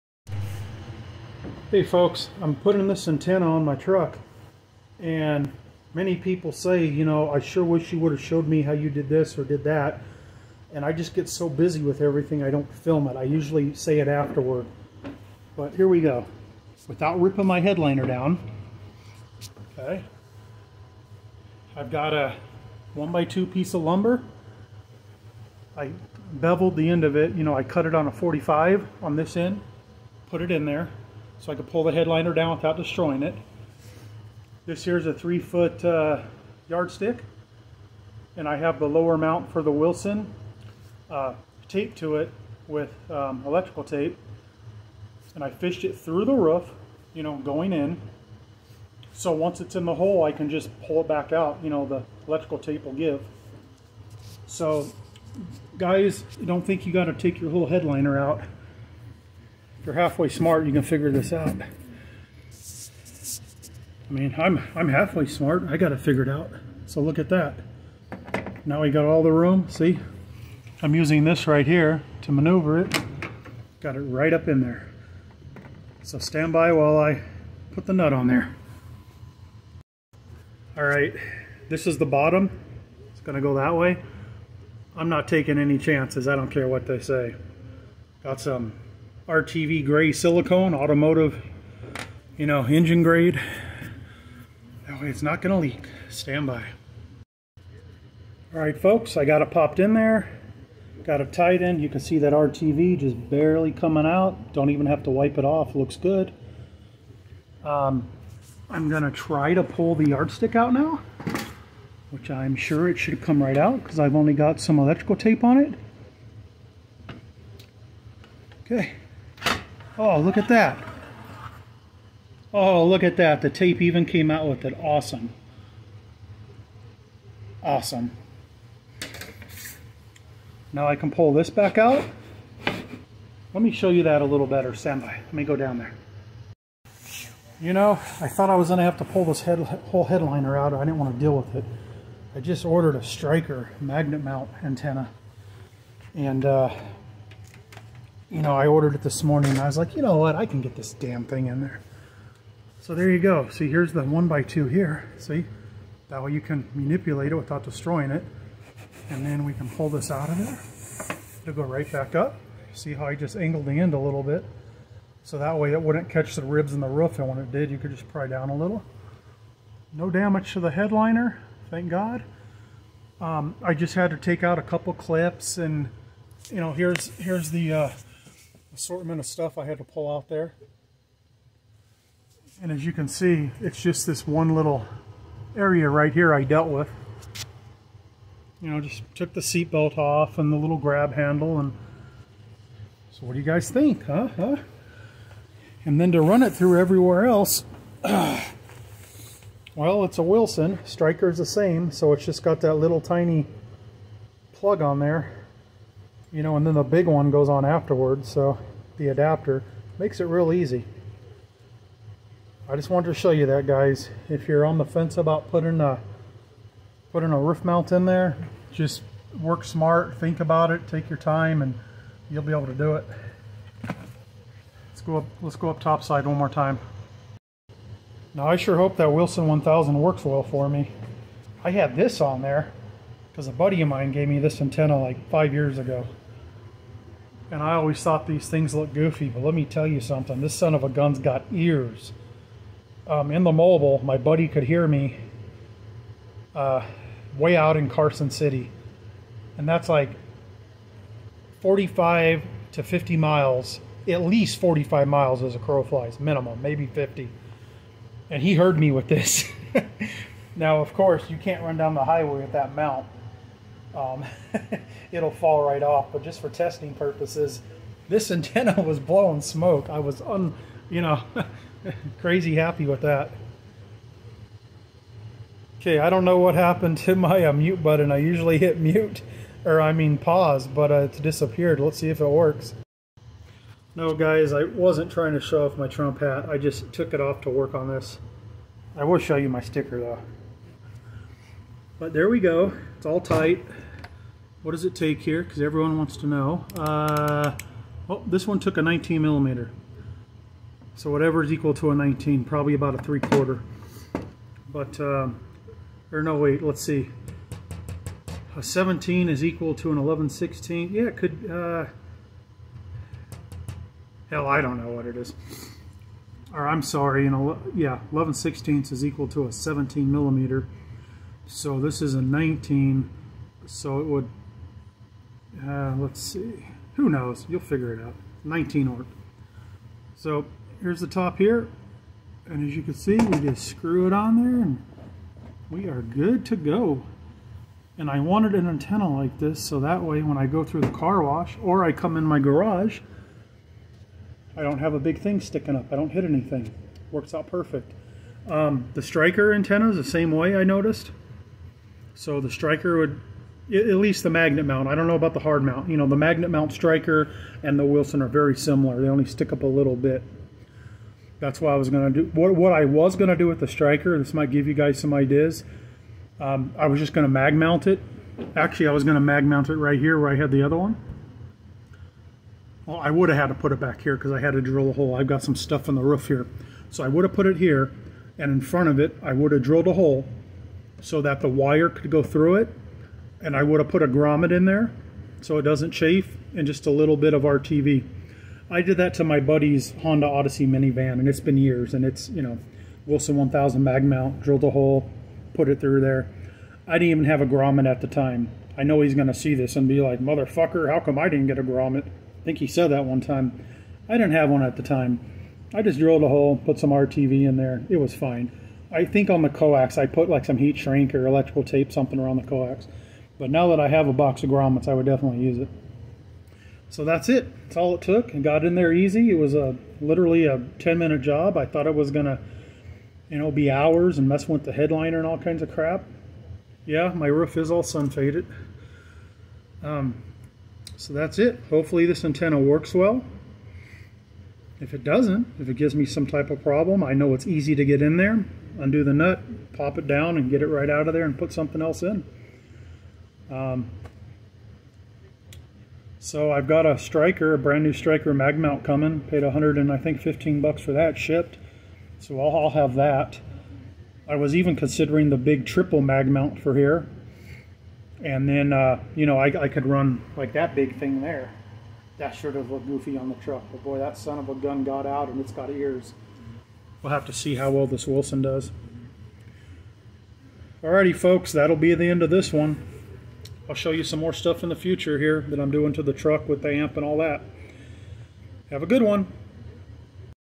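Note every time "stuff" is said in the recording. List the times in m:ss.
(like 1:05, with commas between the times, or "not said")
2:59, 6:15, 7:54.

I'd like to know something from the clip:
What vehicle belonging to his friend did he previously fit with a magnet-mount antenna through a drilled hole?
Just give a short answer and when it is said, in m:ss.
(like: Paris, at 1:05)
Honda Odyssey minivan, at 6:30.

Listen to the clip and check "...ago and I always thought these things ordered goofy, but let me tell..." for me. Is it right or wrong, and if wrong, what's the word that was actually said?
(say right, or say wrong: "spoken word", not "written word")
wrong: "looked", not "ordered".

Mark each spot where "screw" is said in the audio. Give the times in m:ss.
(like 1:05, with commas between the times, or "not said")
5:33.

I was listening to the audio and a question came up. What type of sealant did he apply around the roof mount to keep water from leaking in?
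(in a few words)
RTV gray silicone.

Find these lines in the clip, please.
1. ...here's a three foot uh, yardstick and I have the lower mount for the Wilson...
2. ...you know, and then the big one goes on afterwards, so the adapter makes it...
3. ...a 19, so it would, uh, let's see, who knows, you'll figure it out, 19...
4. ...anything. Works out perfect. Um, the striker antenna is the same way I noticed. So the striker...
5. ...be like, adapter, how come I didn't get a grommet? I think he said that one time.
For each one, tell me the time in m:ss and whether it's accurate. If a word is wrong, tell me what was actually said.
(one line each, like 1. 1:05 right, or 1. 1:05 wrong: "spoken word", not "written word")
1. 0:34 right
2. 3:26 right
3. 5:22 right
4. 5:46 right
5. 6:39 wrong: "motherfucker", not "adapter".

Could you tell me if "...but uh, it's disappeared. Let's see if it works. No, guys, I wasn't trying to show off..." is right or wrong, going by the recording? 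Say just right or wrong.
right.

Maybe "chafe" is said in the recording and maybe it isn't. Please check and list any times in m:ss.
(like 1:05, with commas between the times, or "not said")
6:25.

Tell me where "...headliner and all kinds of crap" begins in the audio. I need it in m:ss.
7:04.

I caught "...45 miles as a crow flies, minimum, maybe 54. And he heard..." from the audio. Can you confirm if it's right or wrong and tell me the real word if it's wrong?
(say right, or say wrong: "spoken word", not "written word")
wrong: "50", not "54".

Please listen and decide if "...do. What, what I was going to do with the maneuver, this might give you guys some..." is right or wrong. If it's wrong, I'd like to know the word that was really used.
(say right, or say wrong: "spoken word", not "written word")
wrong: "striker", not "maneuver".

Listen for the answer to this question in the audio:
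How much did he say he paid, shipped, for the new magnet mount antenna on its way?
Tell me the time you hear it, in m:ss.
7:29.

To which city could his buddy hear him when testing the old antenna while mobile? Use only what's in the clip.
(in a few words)
Carson City.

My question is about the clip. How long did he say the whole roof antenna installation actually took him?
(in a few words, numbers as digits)
10 minutes.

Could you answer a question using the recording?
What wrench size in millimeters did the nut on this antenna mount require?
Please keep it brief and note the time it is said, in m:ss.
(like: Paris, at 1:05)
19 millimeter, at 4:58.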